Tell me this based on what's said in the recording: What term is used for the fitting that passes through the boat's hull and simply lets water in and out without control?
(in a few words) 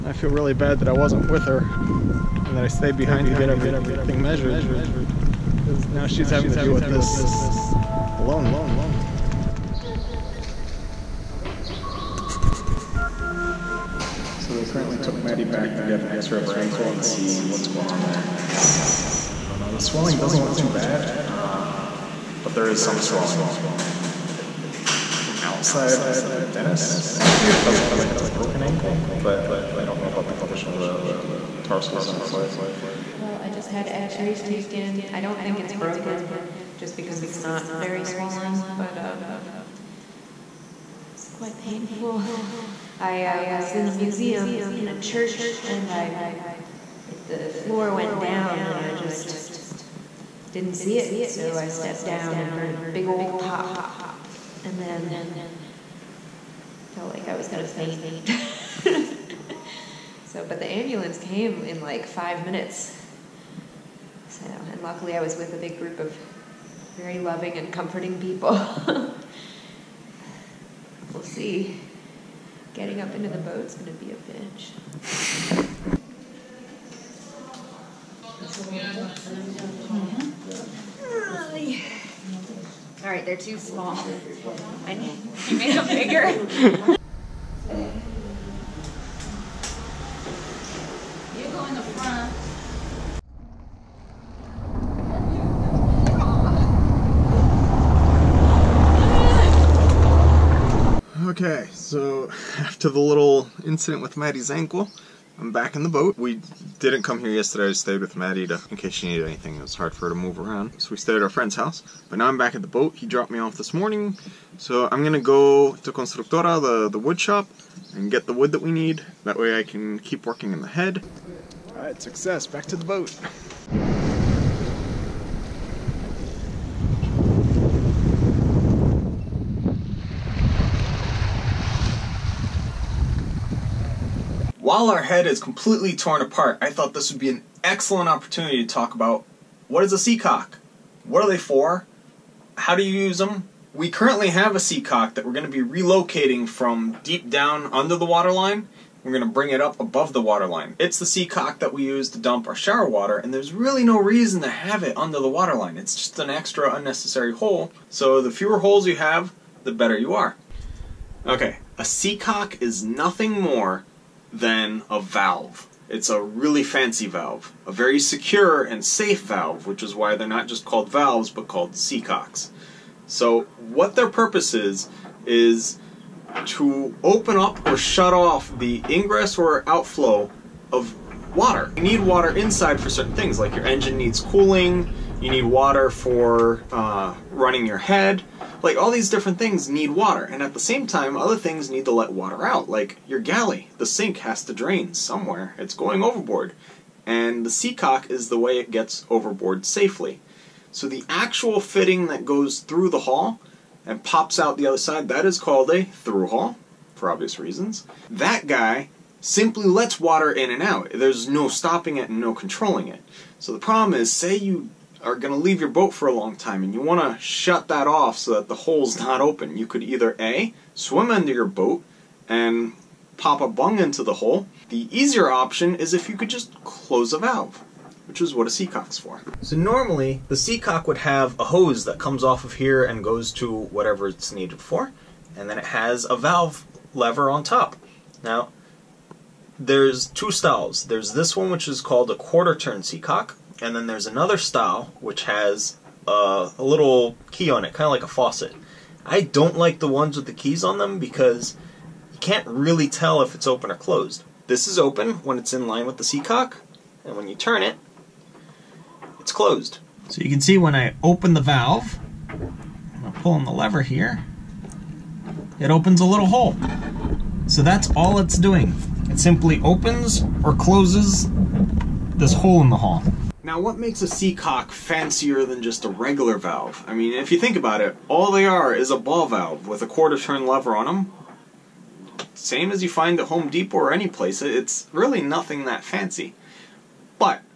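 Through hull.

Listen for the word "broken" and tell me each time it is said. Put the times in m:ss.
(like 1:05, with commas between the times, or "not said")
0:28, 0:35.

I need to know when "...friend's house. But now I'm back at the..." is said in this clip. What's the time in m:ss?
1:51.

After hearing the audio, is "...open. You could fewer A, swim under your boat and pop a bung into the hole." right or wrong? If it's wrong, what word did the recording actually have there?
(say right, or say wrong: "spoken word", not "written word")
wrong: "either", not "fewer".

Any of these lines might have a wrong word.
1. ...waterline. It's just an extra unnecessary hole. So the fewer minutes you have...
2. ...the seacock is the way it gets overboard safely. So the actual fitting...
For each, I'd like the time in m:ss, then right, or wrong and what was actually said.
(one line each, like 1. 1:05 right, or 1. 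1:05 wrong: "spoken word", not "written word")
1. 2:35 wrong: "holes", not "minutes"
2. 3:17 right.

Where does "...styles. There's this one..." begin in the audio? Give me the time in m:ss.
4:00.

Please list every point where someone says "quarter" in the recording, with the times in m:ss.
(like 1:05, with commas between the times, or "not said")
4:02, 4:39.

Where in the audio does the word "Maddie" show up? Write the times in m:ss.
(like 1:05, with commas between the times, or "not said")
0:15, 1:44, 1:48.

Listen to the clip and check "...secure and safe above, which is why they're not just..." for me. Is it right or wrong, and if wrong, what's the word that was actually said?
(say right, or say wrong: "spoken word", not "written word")
wrong: "valve", not "above".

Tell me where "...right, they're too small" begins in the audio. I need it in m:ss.
1:23.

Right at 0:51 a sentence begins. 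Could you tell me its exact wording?
So I stepped down and heard a big old pop.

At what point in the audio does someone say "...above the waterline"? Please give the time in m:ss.
2:29.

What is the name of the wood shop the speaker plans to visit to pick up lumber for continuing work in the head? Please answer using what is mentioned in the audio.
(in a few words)
Constructora.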